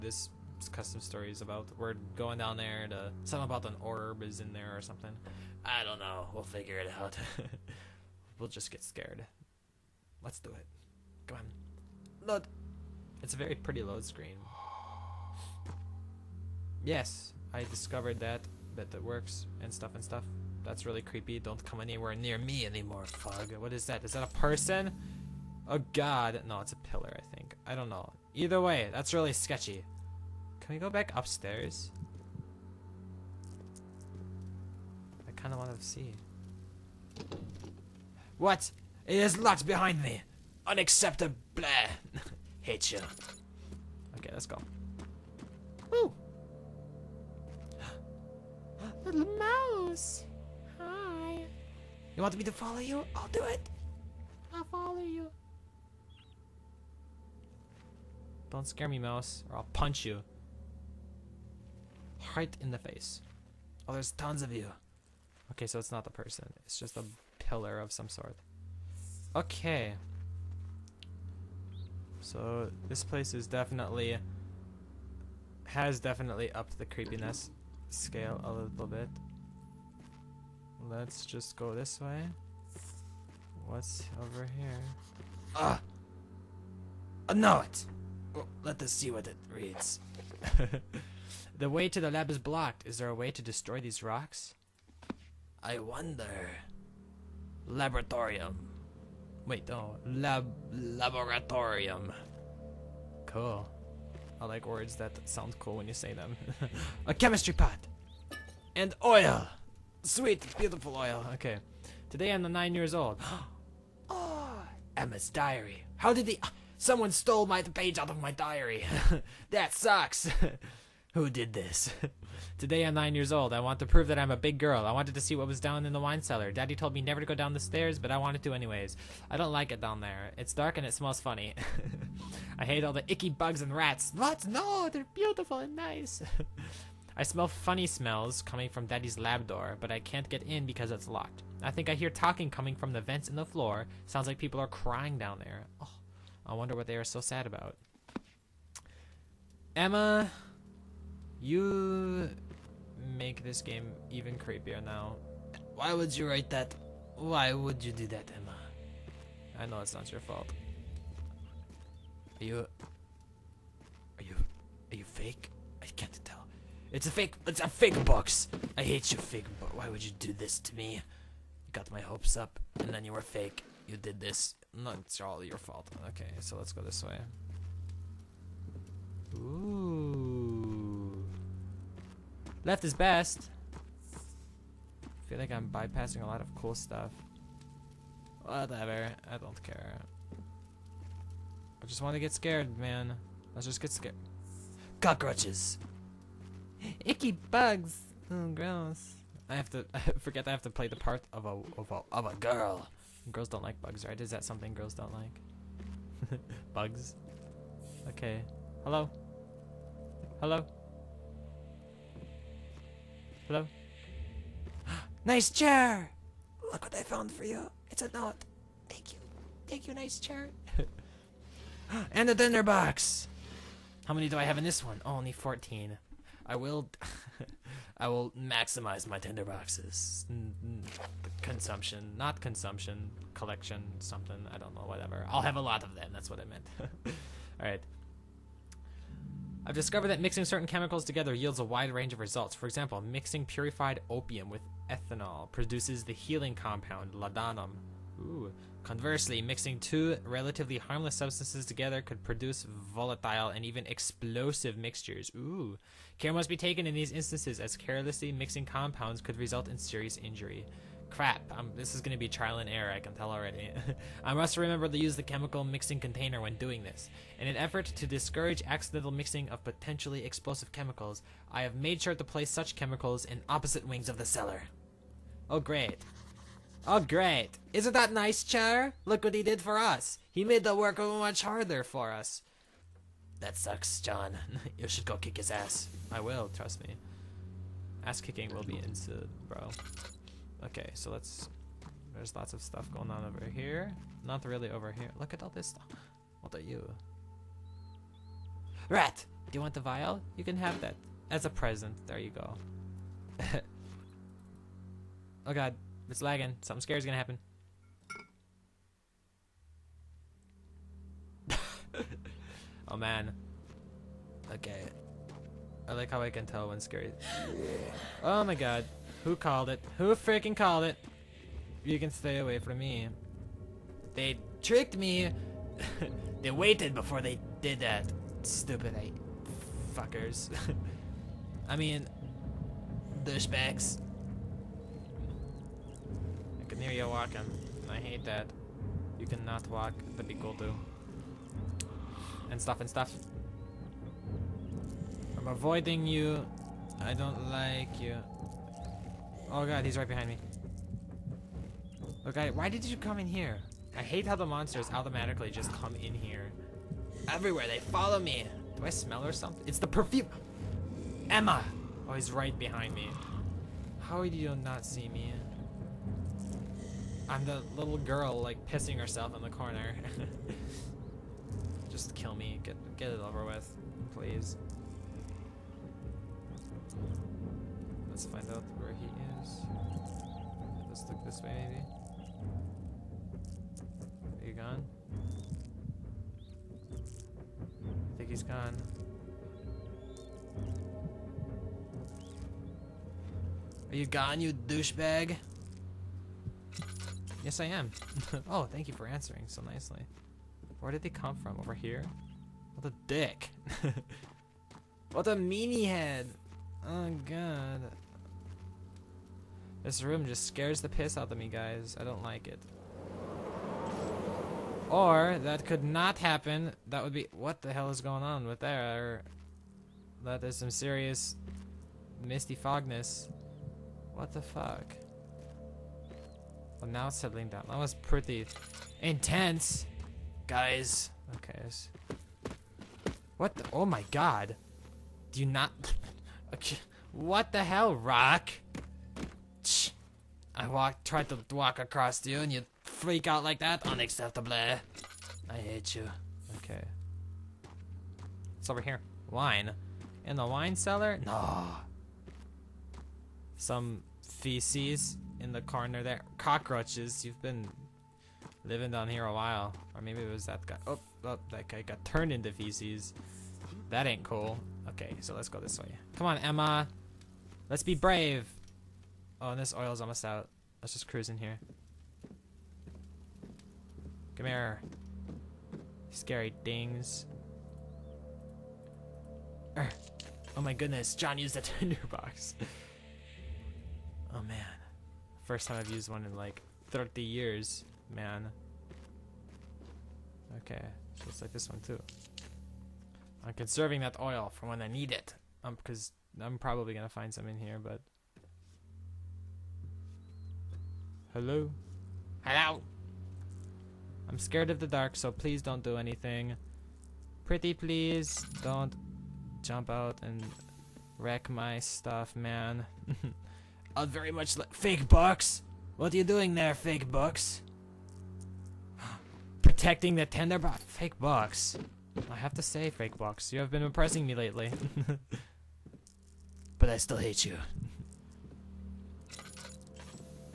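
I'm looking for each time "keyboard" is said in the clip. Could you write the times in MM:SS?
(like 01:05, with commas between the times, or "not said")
not said.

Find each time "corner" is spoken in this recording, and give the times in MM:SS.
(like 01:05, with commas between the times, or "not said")
06:09, 07:35.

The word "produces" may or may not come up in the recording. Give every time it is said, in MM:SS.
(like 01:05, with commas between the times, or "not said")
04:05, 04:12.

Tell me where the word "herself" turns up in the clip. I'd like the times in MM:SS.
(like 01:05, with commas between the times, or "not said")
06:08.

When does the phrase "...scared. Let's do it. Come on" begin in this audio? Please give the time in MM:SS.
00:08.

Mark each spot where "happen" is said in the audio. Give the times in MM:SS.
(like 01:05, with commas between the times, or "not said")
05:07, 06:56.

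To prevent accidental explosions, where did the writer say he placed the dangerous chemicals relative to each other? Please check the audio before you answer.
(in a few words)
opposite wings of the cellar.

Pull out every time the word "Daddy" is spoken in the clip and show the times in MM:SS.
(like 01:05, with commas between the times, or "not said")
02:06, 02:18.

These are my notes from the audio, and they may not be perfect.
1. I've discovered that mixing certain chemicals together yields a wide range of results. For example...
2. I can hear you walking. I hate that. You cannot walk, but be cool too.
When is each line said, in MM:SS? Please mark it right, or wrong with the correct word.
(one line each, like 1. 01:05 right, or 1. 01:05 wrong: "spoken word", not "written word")
1. 03:59 right
2. 05:36 right.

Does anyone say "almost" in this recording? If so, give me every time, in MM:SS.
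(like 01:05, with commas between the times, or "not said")
07:50.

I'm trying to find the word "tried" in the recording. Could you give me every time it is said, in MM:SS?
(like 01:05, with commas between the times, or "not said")
07:21.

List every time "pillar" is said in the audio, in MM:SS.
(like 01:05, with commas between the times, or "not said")
00:26, 01:07.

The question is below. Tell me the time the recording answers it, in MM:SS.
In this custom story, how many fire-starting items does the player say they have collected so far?
03:45.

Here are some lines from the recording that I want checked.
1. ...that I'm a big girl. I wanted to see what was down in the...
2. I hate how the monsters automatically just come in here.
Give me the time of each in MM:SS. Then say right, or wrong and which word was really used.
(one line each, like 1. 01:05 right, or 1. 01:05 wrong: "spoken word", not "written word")
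1. 02:04 right
2. 05:53 right.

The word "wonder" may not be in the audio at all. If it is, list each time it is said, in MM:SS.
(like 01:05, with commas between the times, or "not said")
01:35, 02:26.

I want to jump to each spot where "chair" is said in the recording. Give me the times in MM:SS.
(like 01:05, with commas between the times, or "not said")
03:35, 03:40.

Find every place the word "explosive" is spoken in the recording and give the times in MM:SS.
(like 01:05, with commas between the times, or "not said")
04:13, 04:30.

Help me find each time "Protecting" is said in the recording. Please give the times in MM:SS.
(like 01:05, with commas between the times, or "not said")
08:39.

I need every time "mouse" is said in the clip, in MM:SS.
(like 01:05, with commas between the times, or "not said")
00:49, 00:58.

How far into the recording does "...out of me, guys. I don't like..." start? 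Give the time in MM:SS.
06:51.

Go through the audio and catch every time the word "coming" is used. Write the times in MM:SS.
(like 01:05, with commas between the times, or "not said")
02:18, 02:22.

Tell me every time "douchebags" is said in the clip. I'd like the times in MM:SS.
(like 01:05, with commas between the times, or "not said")
05:33, 06:34.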